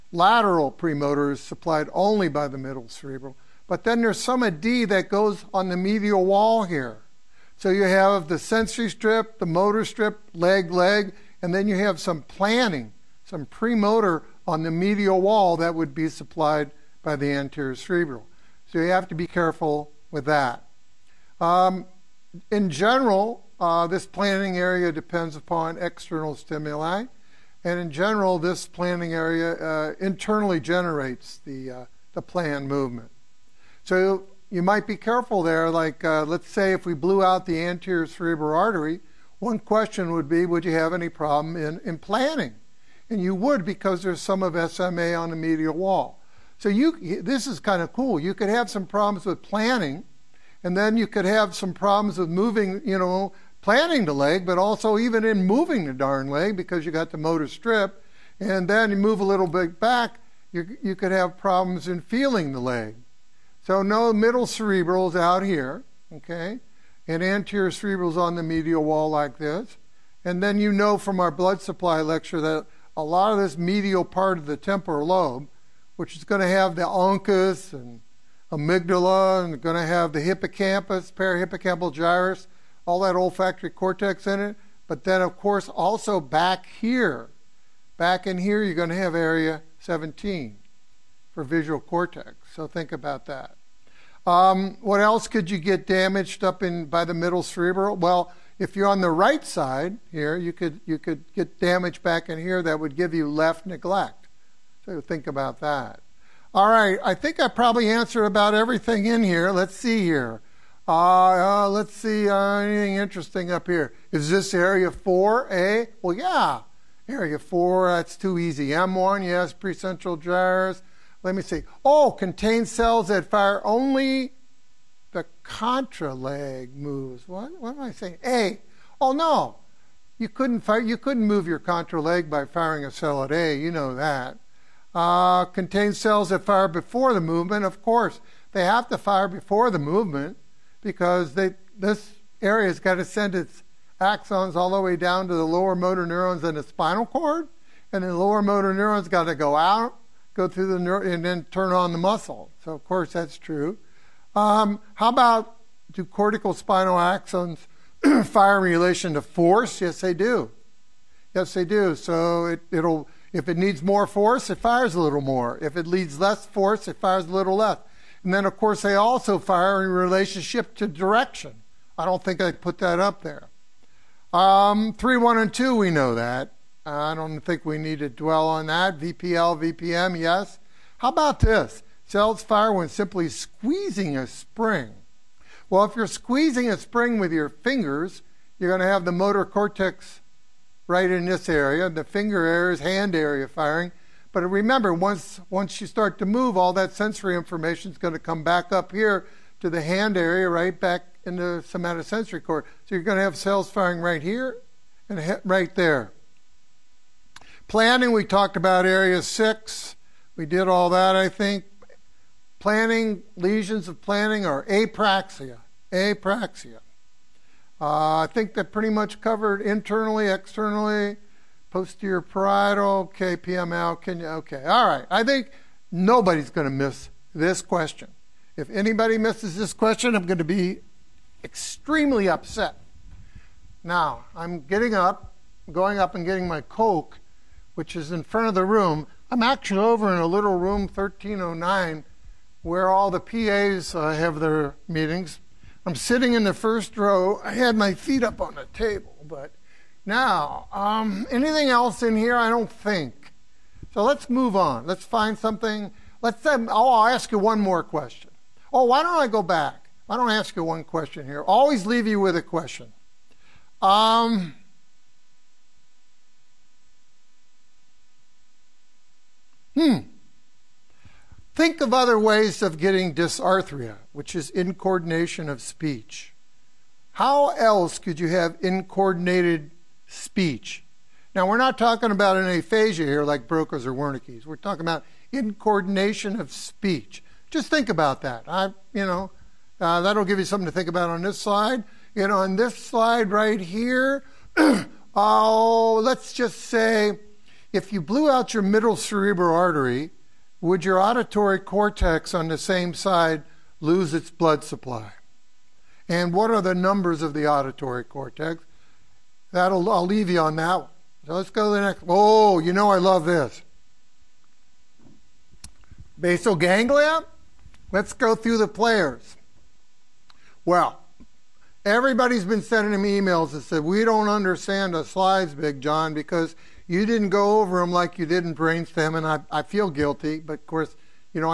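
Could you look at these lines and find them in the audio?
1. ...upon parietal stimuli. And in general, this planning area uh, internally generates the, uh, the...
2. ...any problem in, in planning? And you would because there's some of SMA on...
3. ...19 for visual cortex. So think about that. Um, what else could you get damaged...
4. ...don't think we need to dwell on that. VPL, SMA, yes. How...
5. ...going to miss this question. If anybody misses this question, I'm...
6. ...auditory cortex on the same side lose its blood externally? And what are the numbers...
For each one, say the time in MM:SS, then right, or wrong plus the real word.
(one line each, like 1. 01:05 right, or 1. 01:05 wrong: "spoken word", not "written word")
1. 00:25 wrong: "external", not "parietal"
2. 00:40 right
3. 01:29 wrong: "17", not "19"
4. 02:57 wrong: "VPM", not "SMA"
5. 03:46 right
6. 05:01 wrong: "supply", not "externally".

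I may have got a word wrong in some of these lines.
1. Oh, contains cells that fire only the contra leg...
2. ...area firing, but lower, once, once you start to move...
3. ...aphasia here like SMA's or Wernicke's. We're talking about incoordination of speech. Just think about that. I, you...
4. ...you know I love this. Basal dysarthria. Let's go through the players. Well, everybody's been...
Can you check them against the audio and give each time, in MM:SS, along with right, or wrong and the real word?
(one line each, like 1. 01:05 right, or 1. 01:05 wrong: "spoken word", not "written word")
1. 02:01 right
2. 03:13 wrong: "remember", not "lower"
3. 04:42 wrong: "Broca", not "SMA"
4. 05:12 wrong: "ganglia", not "dysarthria".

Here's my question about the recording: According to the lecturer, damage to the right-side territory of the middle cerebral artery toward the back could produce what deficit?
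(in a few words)
left neglect.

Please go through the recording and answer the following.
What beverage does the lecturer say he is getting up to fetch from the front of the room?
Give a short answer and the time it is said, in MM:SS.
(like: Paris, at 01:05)
Coke, at 03:56.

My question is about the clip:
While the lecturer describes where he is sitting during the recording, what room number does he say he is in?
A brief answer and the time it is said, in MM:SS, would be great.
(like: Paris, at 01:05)
1309, at 04:00.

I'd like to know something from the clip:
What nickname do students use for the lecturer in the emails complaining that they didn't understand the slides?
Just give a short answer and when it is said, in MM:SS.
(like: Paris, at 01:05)
Big John, at 05:25.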